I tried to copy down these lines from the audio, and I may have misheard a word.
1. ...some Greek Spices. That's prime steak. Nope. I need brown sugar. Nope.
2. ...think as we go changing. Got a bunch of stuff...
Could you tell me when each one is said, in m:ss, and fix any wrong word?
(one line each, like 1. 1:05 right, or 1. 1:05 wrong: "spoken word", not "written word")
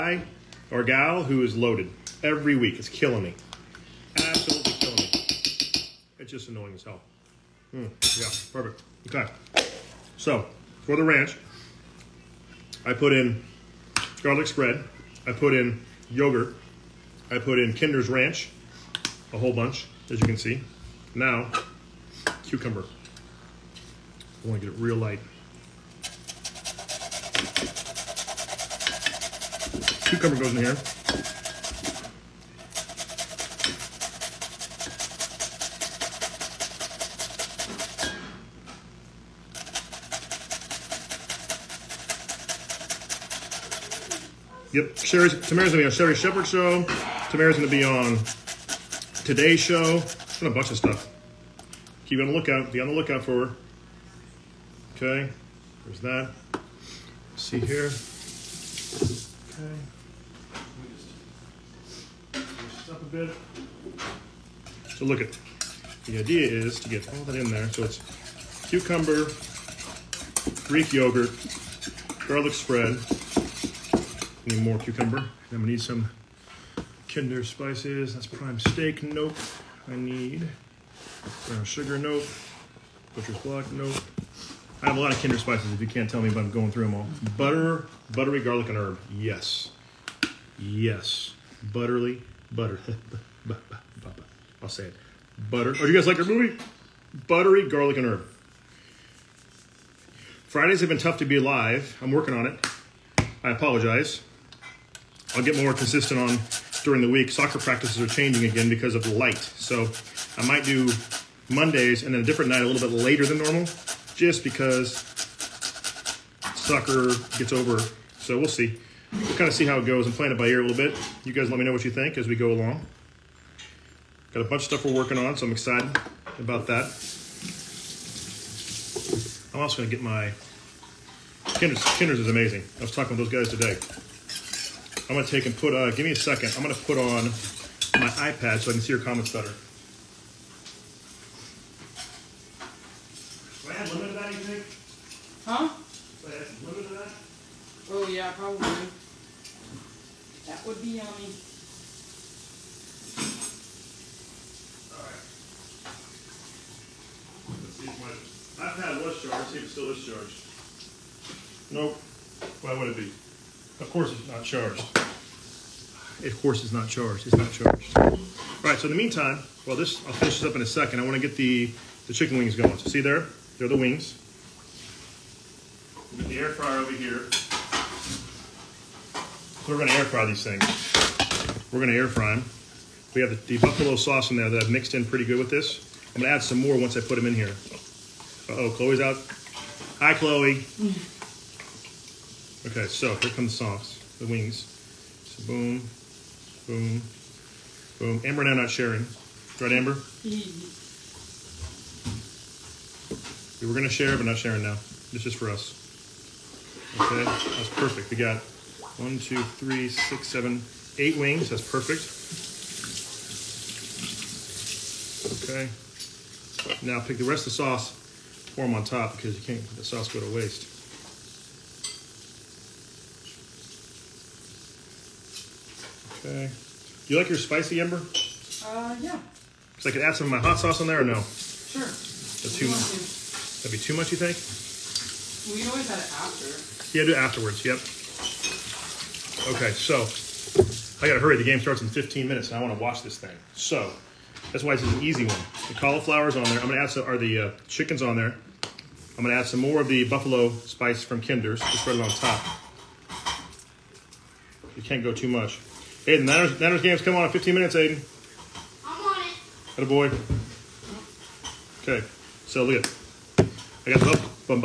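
1. 1:15 wrong: "Kinder", not "Greek"
2. 2:01 wrong: "along", not "changing".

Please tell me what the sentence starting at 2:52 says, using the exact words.
So see there, they're the wings.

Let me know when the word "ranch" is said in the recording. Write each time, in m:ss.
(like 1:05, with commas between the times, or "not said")
0:11, 0:18.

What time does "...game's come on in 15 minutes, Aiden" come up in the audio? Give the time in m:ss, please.
4:16.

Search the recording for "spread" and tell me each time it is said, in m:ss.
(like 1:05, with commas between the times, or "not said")
0:14, 1:12, 4:11.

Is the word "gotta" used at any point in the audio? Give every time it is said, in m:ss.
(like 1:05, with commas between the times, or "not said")
4:01.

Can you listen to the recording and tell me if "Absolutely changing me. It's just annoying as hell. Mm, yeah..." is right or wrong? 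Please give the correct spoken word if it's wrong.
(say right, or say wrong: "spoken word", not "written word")
wrong: "killing", not "changing".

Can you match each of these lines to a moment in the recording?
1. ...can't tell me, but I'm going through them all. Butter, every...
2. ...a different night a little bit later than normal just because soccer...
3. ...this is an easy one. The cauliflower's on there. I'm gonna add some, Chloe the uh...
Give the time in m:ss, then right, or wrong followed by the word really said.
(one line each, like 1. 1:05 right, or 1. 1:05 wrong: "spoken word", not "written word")
1. 1:25 wrong: "buttery", not "every"
2. 1:52 right
3. 4:04 wrong: "Are", not "Chloe".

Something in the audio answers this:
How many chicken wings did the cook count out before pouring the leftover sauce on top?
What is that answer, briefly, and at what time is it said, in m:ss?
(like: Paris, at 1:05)
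8, at 3:30.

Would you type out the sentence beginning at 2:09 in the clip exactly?
I'm also going to get my...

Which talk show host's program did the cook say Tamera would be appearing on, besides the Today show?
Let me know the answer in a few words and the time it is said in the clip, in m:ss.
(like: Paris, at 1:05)
Sherri Shepherd, at 0:45.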